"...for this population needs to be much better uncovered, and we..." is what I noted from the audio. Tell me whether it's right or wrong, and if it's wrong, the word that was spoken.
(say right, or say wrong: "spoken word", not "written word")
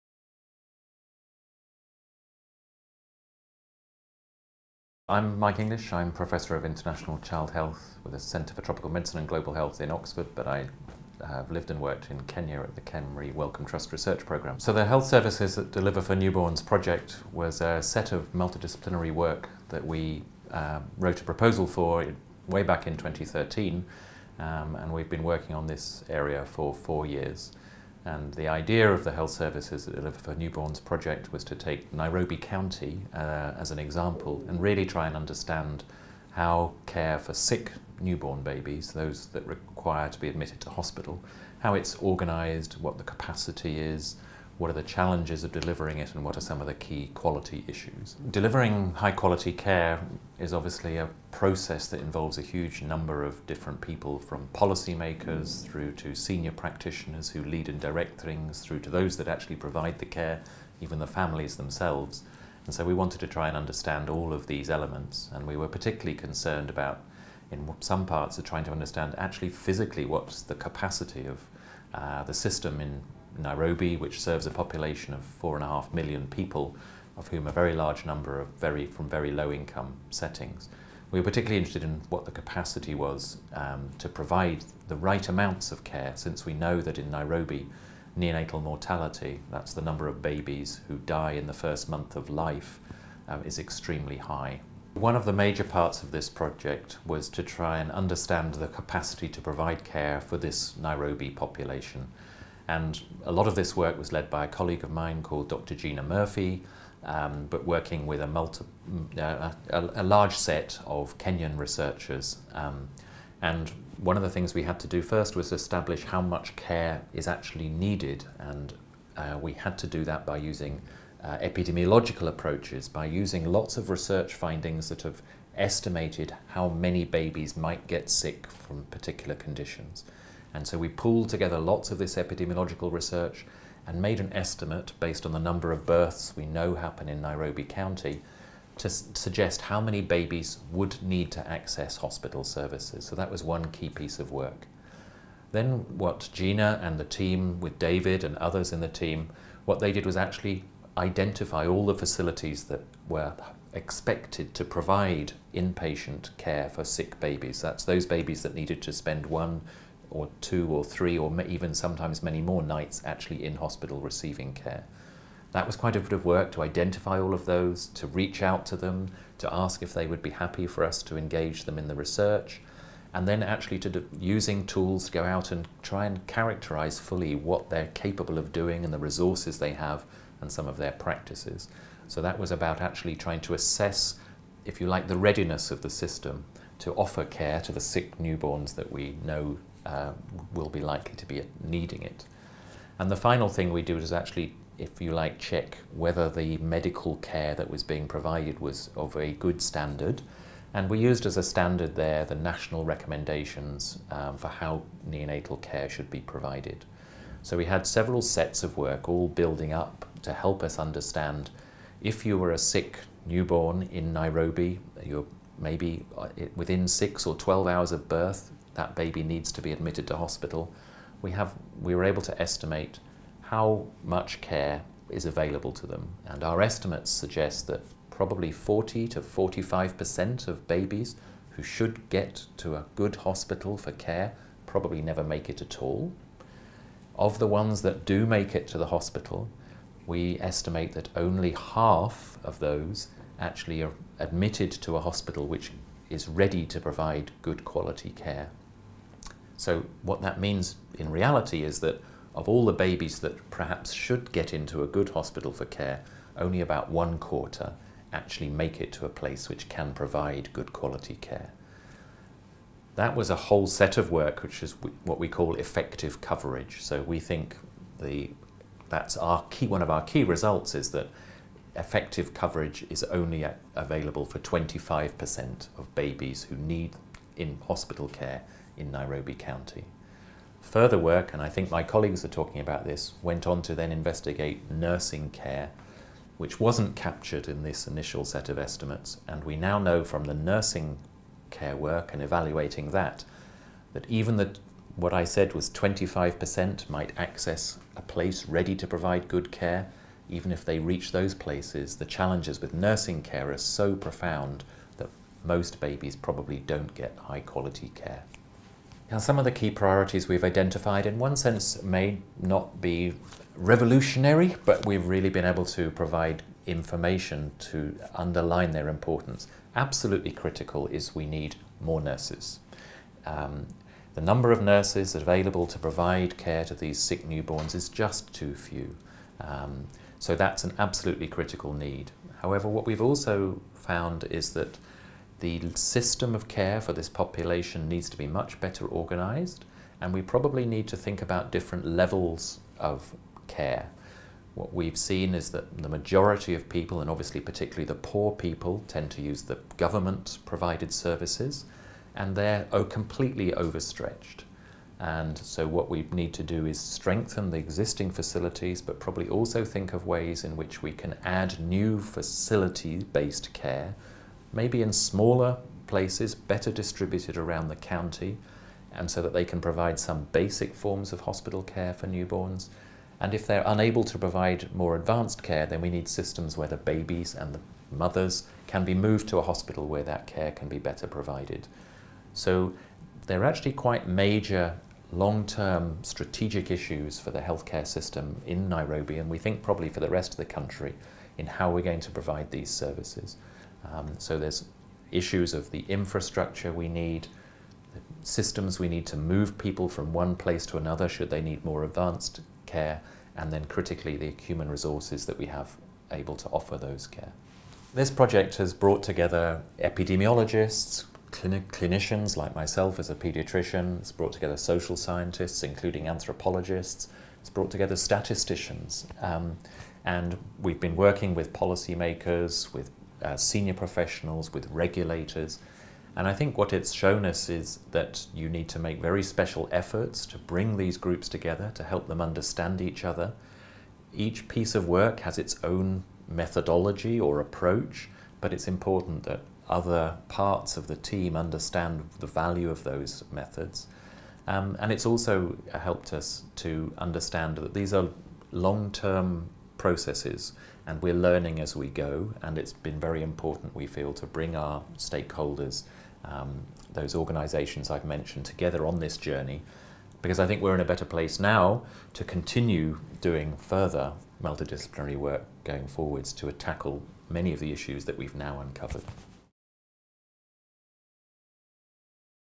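wrong: "organized", not "uncovered".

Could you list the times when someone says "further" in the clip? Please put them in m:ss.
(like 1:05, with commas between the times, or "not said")
4:40, 7:43.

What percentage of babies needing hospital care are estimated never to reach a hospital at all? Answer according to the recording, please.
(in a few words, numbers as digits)
40 to 45%.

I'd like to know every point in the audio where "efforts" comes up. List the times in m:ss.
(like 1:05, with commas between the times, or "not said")
7:09.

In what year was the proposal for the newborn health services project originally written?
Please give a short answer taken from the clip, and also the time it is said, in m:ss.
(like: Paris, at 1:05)
2013, at 0:22.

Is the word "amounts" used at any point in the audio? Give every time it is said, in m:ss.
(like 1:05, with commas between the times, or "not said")
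1:25.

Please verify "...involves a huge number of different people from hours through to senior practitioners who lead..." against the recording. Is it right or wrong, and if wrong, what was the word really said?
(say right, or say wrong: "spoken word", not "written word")
wrong: "policymakers", not "hours".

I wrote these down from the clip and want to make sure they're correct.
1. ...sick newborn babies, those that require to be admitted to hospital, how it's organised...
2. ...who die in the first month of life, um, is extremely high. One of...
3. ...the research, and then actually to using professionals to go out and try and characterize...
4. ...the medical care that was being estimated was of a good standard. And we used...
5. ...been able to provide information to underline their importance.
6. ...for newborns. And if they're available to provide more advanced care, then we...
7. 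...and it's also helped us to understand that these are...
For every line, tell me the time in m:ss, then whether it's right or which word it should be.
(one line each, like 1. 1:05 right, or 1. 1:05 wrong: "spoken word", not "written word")
1. 0:37 right
2. 1:30 right
3. 2:51 wrong: "tools", not "professionals"
4. 3:16 wrong: "provided", not "estimated"
5. 5:15 right
6. 6:11 wrong: "unable", not "available"
7. 7:24 right.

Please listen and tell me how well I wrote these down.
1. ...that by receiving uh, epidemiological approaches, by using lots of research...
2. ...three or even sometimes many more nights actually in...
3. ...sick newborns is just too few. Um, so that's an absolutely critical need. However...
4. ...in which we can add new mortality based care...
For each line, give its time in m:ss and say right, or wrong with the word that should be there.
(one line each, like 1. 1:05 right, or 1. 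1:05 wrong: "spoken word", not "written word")
1. 2:00 wrong: "using", not "receiving"
2. 2:40 right
3. 5:26 right
4. 6:00 wrong: "facility", not "mortality".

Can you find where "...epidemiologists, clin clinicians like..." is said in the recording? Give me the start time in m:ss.
6:49.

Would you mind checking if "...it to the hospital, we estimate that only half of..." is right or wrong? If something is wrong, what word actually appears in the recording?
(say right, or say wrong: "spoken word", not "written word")
right.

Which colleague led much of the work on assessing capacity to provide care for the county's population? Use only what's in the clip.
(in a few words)
Dr. Gina Murphy.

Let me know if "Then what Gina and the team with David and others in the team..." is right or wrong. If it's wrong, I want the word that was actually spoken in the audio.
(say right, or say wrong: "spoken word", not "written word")
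right.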